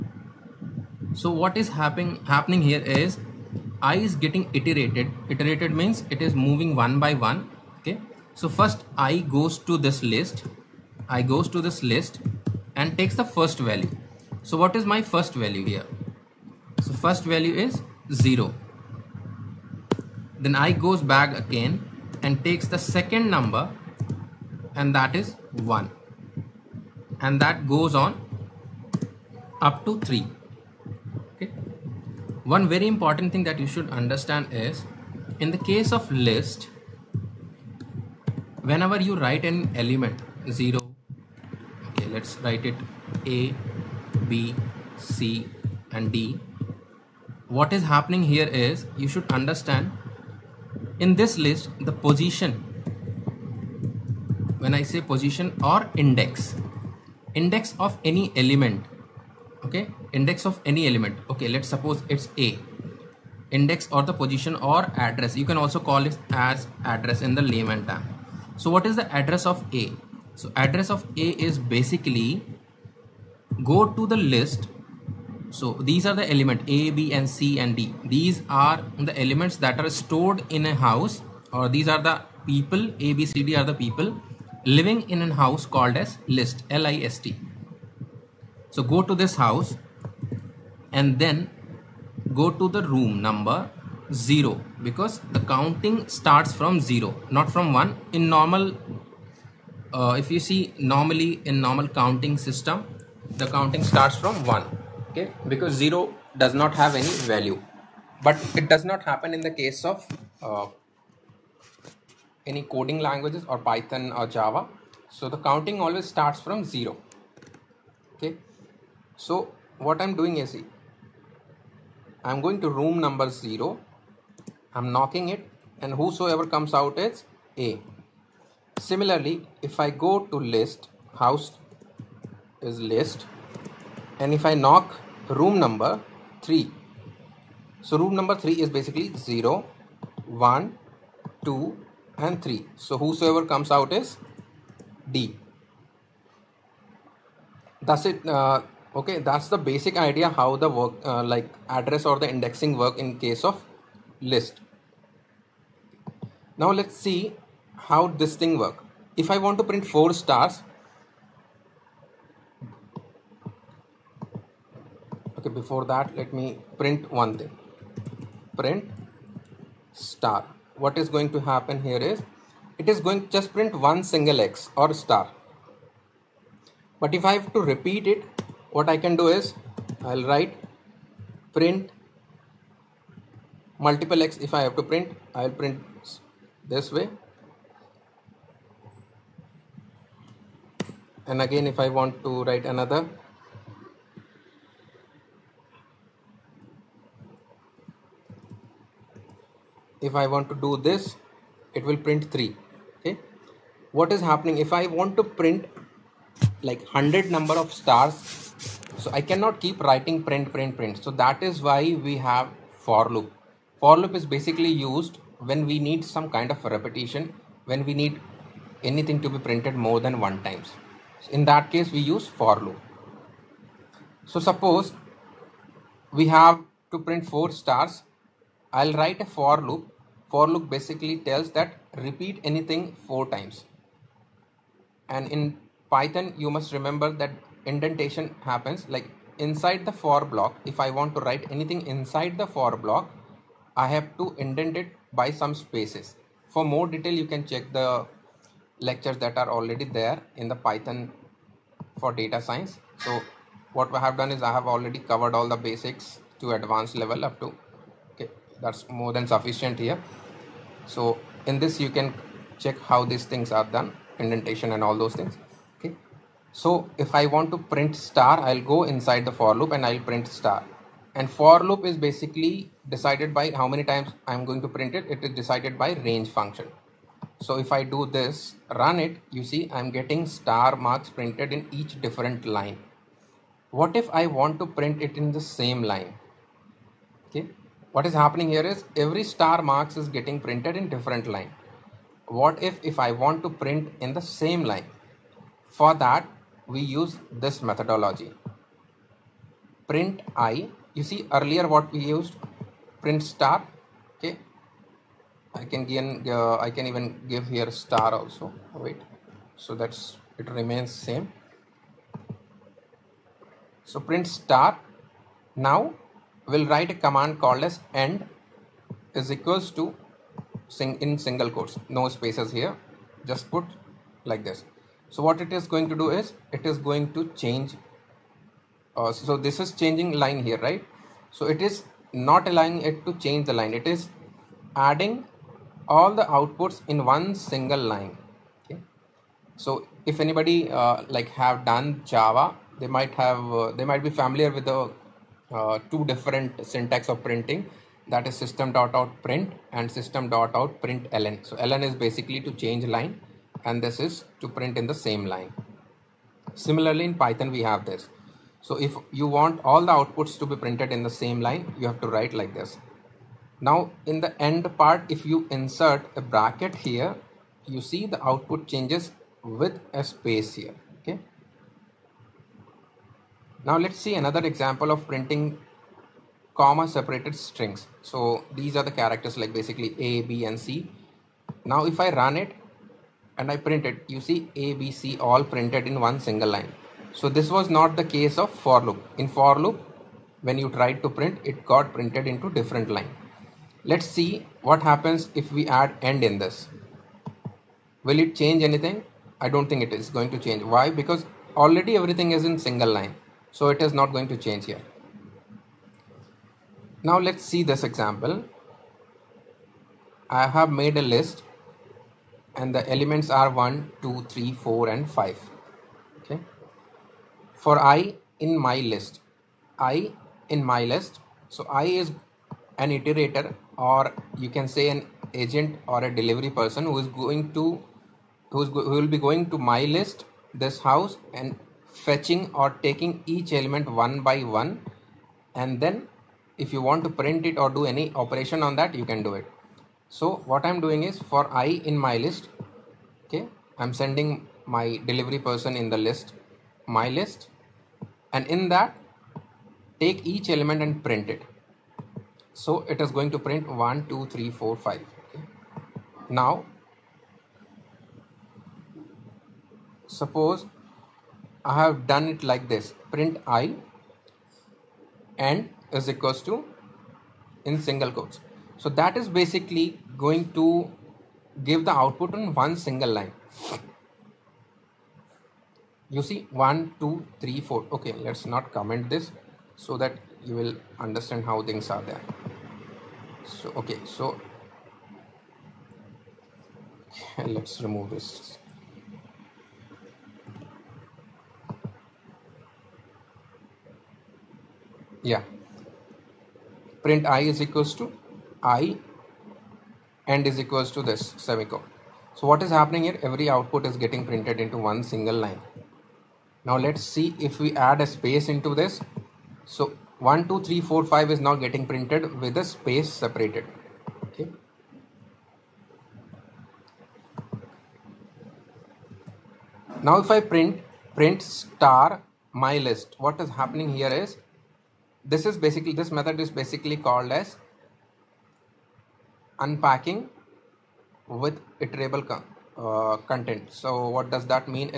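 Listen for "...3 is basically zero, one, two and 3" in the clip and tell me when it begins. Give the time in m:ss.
2:18.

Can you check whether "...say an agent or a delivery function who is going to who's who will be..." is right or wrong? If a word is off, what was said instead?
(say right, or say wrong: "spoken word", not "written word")
wrong: "person", not "function".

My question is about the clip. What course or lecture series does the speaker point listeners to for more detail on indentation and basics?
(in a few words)
Python for data science.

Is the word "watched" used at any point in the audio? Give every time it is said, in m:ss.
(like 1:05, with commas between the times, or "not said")
not said.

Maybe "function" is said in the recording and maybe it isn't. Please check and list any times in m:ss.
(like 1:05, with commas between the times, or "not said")
4:36.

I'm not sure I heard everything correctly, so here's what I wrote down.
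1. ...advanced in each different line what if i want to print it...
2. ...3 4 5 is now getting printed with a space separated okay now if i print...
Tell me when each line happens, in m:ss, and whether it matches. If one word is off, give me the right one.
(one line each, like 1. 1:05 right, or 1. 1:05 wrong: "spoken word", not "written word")
1. 4:41 wrong: "printed", not "advanced"
2. 8:30 right.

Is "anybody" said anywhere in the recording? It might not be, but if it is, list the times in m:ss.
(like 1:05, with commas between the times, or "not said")
5:40.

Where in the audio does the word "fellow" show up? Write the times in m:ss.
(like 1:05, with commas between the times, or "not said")
not said.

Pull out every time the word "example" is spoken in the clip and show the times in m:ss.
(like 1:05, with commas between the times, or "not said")
6:14, 6:47.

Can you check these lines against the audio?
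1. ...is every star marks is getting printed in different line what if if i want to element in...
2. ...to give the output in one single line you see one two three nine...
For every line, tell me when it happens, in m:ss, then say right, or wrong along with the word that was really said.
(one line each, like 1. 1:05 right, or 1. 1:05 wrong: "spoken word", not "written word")
1. 4:48 wrong: "print", not "element"
2. 7:50 wrong: "four", not "nine".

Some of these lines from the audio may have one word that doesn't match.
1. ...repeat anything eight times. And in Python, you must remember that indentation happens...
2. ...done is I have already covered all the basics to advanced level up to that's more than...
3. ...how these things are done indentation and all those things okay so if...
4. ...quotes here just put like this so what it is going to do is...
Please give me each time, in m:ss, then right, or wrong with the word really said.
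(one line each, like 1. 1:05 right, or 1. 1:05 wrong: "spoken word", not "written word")
1. 3:51 wrong: "four", not "eight"
2. 4:14 right
3. 4:22 right
4. 5:22 wrong: "spaces", not "quotes".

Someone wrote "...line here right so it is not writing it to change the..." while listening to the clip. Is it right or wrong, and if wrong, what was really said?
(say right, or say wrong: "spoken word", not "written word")
wrong: "allowing", not "writing".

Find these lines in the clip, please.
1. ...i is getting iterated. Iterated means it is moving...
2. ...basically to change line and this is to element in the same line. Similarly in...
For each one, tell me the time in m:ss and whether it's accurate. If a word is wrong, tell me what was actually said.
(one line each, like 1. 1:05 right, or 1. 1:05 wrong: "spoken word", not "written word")
1. 0:03 right
2. 5:52 wrong: "print", not "element".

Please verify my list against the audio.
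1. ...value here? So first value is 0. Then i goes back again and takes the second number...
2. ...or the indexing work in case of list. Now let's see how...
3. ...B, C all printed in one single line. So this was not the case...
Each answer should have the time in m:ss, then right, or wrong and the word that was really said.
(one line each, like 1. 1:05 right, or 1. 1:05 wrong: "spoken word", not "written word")
1. 0:15 right
2. 2:32 right
3. 6:24 right.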